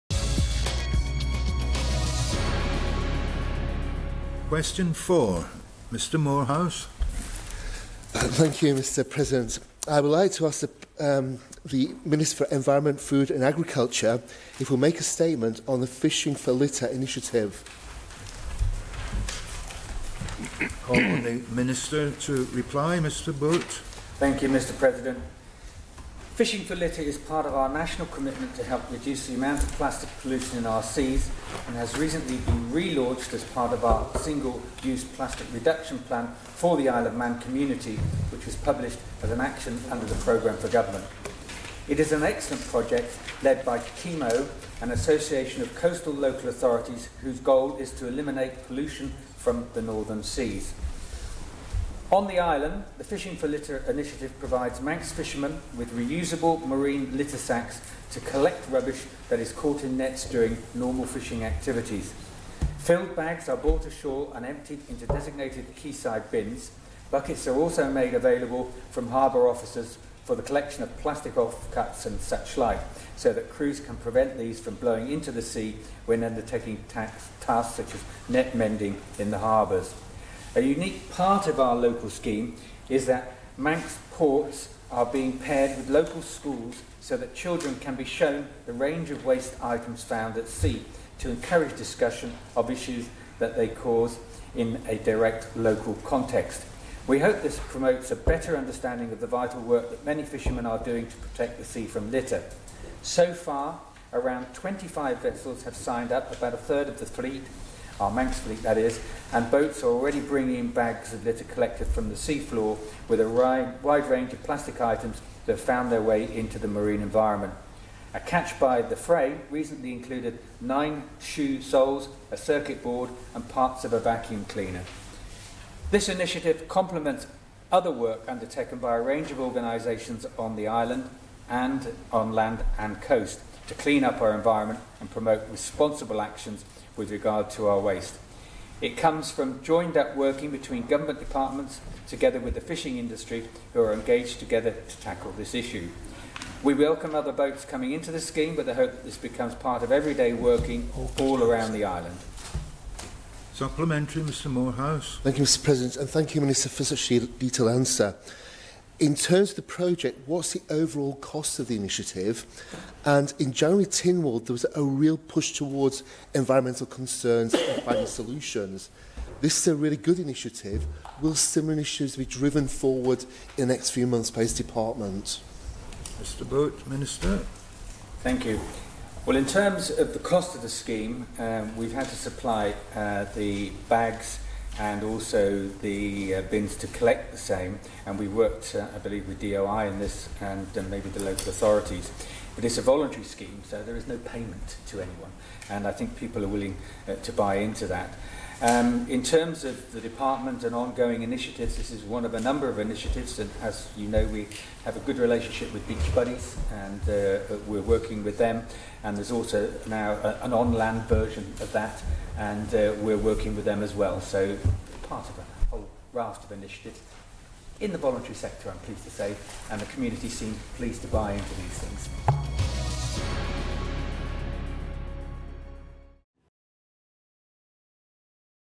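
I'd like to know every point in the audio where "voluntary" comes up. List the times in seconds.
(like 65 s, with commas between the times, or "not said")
192 s, 217 s.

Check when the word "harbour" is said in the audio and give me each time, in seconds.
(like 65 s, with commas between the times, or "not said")
69 s, 79 s.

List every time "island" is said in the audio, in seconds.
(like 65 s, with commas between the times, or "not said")
52 s, 130 s, 151 s.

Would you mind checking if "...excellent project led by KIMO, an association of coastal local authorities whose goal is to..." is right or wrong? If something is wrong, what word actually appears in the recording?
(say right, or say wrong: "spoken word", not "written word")
right.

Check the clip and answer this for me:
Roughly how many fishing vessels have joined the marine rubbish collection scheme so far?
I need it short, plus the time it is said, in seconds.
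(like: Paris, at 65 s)
25, at 104 s.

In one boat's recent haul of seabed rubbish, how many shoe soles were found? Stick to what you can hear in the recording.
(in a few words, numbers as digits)
9.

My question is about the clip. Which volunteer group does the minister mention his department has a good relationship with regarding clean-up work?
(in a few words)
Beach Buddies.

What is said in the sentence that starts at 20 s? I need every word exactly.
Call on the Minister to reply, Mr Boot.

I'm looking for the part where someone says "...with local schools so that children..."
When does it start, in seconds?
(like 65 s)
85 s.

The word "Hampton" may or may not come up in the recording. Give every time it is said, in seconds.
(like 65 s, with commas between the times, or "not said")
not said.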